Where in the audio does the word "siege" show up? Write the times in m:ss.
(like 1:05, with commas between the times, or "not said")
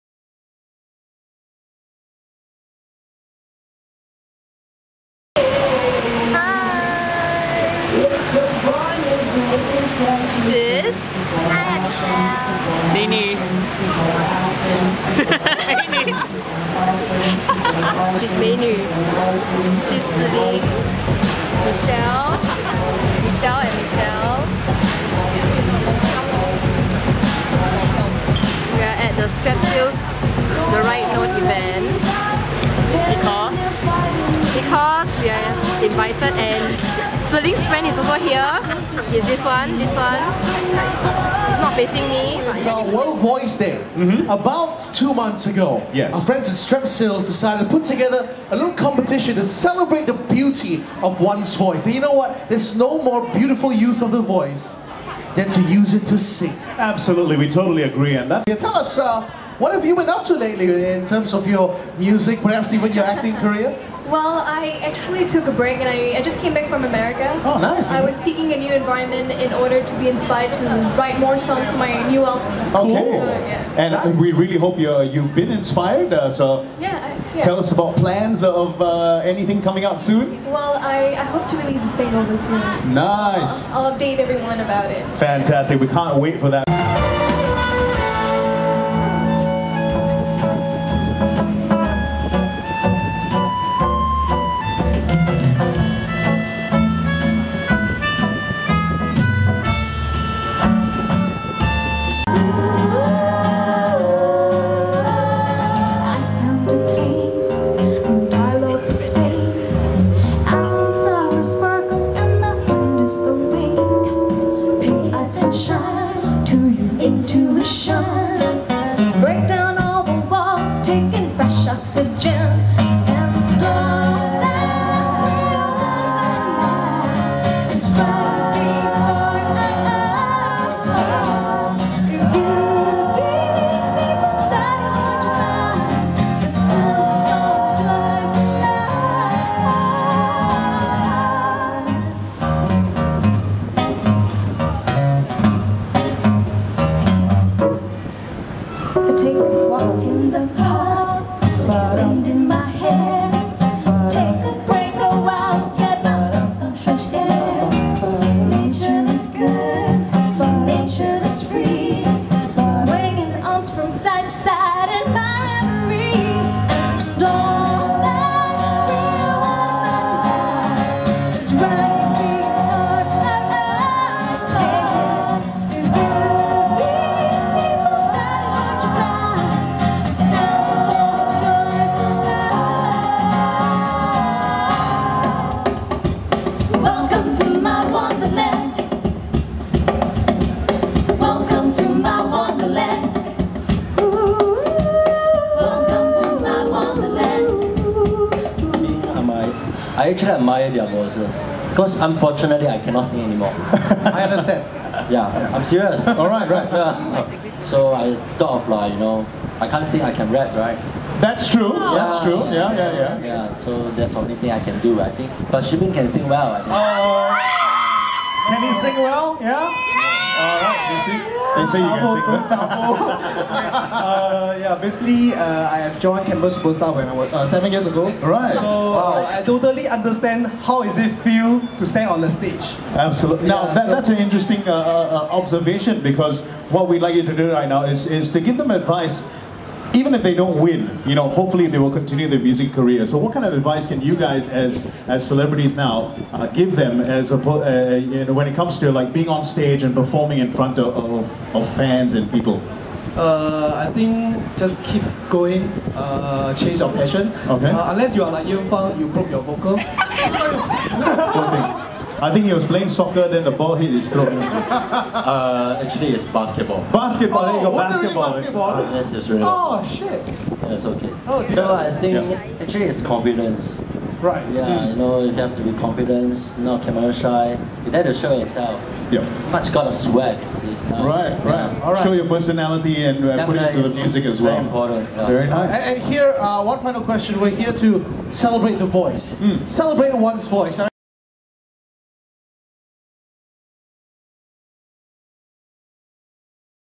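not said.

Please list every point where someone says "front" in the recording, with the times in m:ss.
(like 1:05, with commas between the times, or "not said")
4:10.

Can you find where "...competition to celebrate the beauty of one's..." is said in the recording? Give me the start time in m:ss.
0:48.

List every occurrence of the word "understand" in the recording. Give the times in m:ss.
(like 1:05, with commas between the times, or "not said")
3:24, 3:49.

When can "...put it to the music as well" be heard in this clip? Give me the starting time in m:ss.
4:43.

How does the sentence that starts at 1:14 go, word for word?
Uh, we really hope you uh, you've been inspired.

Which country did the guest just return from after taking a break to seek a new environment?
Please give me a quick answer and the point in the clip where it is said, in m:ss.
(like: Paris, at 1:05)
America, at 1:06.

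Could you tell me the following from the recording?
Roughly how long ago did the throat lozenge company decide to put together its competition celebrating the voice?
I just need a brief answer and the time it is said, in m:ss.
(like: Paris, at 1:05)
About 2 months ago, at 0:44.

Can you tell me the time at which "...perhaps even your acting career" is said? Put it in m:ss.
1:02.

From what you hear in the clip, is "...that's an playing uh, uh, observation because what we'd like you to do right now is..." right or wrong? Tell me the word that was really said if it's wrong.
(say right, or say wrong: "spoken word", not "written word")
wrong: "interesting", not "playing".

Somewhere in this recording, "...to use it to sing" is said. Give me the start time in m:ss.
0:55.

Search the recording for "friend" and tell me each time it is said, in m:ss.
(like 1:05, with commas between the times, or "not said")
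0:37, 0:46.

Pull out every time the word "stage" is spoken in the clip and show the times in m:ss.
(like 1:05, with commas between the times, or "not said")
3:52, 4:09.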